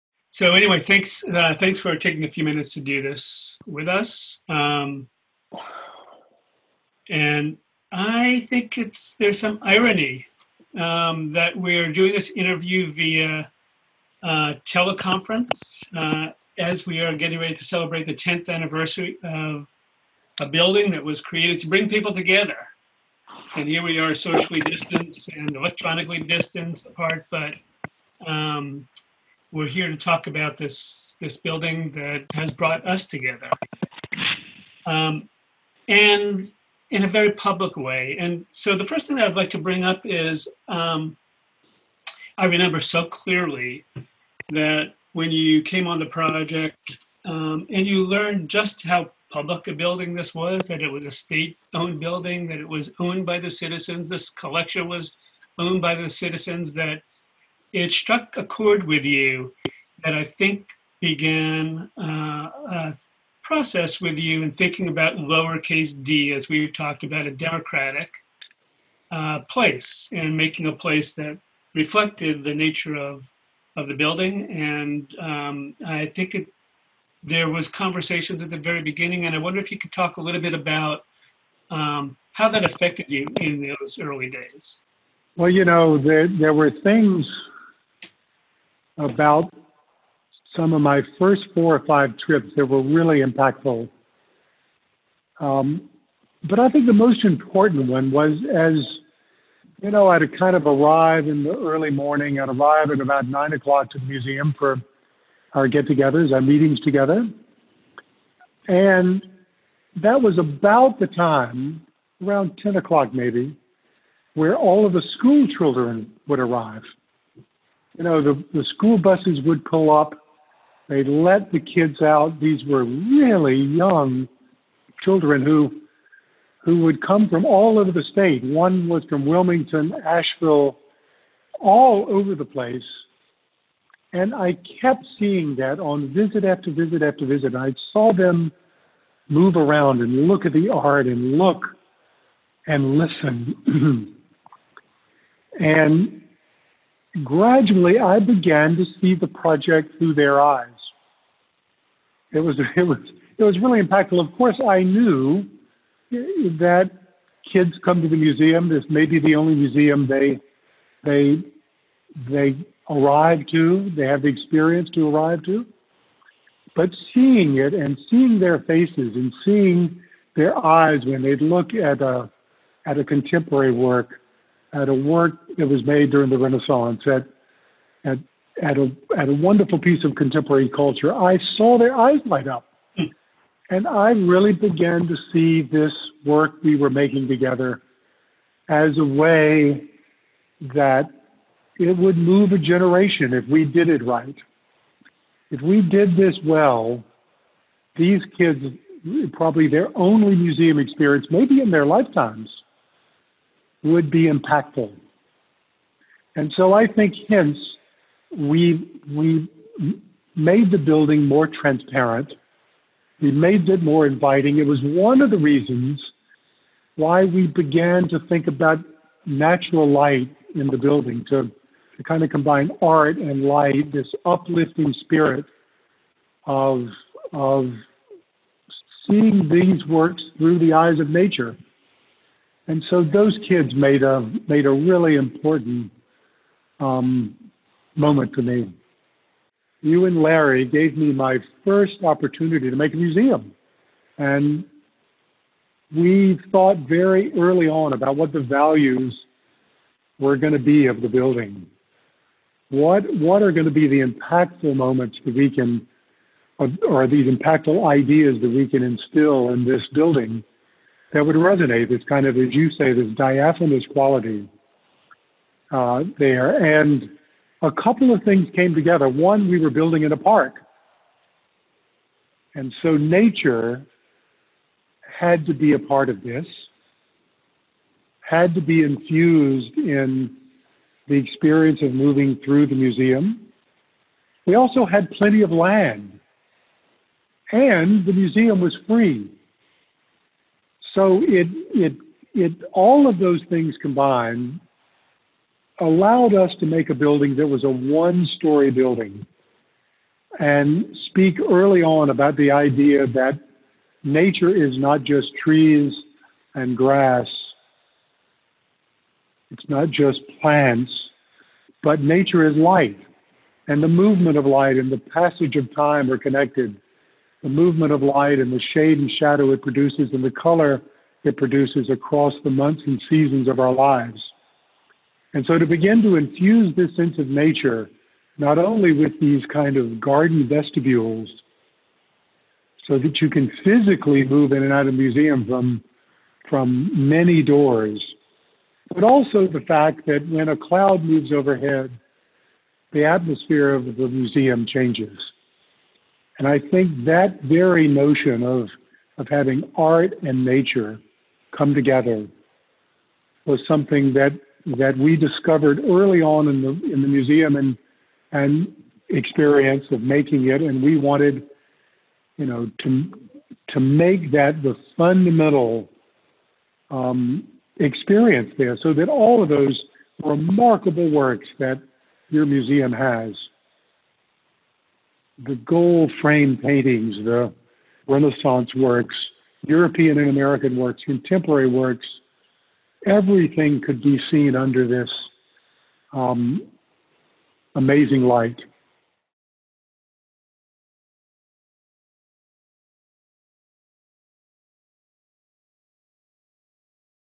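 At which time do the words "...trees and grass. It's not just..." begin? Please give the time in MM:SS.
05:05.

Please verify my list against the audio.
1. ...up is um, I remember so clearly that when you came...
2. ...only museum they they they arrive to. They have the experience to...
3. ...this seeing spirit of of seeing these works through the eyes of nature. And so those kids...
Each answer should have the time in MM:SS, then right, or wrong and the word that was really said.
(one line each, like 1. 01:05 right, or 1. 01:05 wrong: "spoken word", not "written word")
1. 00:39 right
2. 02:39 right
3. 03:43 wrong: "uplifting", not "seeing".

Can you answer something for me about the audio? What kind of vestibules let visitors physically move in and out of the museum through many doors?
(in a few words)
Garden vestibules.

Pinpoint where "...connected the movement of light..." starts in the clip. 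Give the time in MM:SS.
05:16.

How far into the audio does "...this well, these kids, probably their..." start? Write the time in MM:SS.
03:16.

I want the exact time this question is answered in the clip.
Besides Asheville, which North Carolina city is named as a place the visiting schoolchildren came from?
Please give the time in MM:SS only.
02:09.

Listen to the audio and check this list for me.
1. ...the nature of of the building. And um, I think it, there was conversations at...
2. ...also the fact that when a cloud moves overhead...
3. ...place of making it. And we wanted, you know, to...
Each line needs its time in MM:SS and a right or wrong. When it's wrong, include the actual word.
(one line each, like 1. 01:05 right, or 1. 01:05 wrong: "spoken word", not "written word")
1. 01:12 right
2. 05:39 right
3. 05:59 wrong: "experience", not "place".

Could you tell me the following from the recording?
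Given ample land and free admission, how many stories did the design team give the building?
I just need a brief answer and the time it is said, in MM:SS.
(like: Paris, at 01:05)
1, at 04:57.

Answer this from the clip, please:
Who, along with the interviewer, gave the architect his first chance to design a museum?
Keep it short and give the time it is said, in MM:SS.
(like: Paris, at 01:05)
Larry, at 04:00.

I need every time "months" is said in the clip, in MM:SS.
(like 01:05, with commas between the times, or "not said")
05:22.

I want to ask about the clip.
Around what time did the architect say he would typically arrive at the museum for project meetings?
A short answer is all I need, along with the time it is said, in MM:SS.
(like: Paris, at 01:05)
9 o'clock, at 01:43.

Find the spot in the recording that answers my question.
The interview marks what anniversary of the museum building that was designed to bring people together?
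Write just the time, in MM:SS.
00:18.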